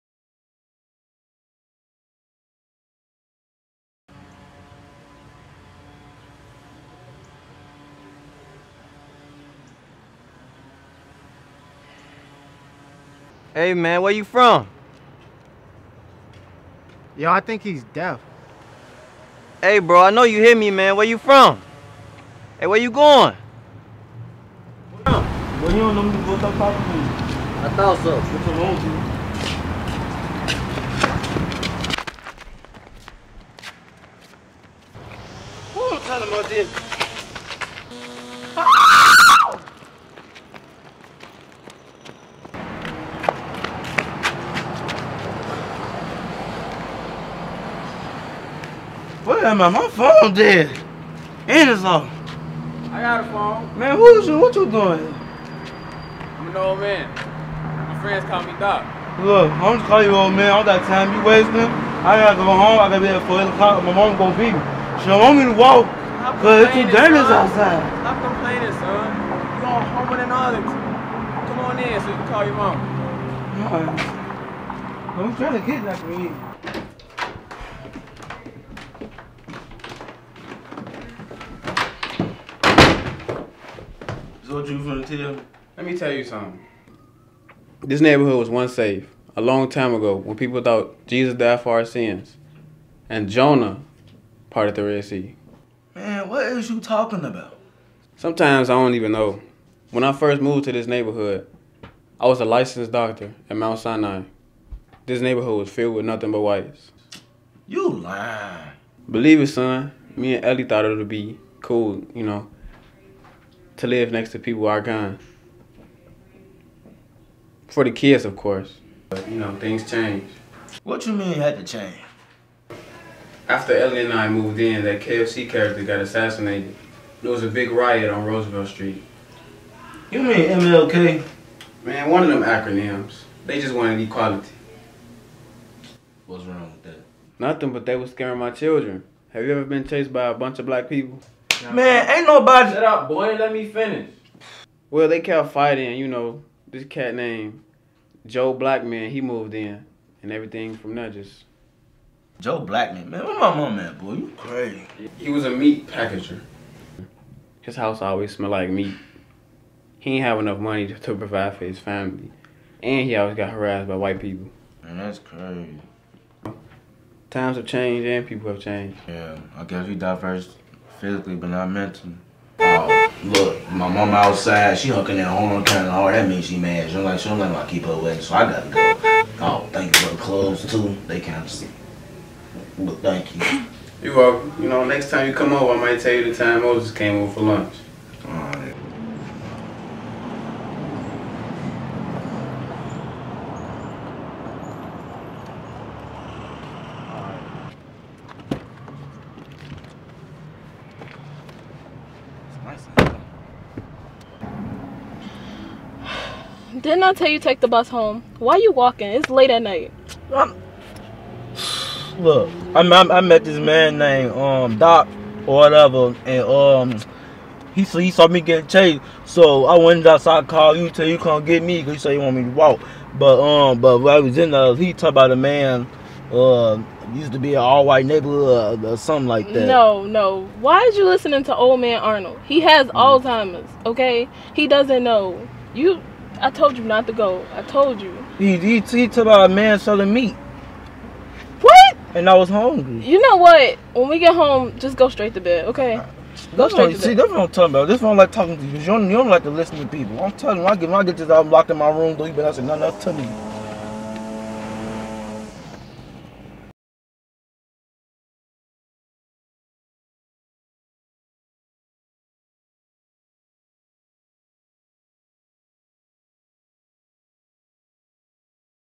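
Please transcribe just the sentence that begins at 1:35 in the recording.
Man, what is you talking about?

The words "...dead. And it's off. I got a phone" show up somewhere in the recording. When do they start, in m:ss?
0:50.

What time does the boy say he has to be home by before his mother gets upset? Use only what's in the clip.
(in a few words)
4 o'clock.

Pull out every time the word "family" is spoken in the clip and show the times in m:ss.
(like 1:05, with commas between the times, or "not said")
2:41.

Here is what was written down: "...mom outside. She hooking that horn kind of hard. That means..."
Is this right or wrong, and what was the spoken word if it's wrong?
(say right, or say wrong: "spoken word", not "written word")
right.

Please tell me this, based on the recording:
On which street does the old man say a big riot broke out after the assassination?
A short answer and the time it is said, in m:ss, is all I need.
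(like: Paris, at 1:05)
Roosevelt Street, at 2:08.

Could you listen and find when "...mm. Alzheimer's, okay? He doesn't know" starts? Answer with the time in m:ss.
3:52.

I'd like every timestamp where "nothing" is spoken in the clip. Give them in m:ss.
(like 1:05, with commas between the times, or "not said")
1:46, 2:17, 4:12.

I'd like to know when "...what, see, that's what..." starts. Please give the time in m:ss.
4:06.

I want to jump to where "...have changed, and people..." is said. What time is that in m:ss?
2:47.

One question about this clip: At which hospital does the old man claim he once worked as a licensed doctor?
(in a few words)
Mount Sinai.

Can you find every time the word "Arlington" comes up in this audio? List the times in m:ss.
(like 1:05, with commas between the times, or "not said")
1:10.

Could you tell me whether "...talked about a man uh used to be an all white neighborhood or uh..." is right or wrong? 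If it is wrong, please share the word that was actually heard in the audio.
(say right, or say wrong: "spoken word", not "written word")
right.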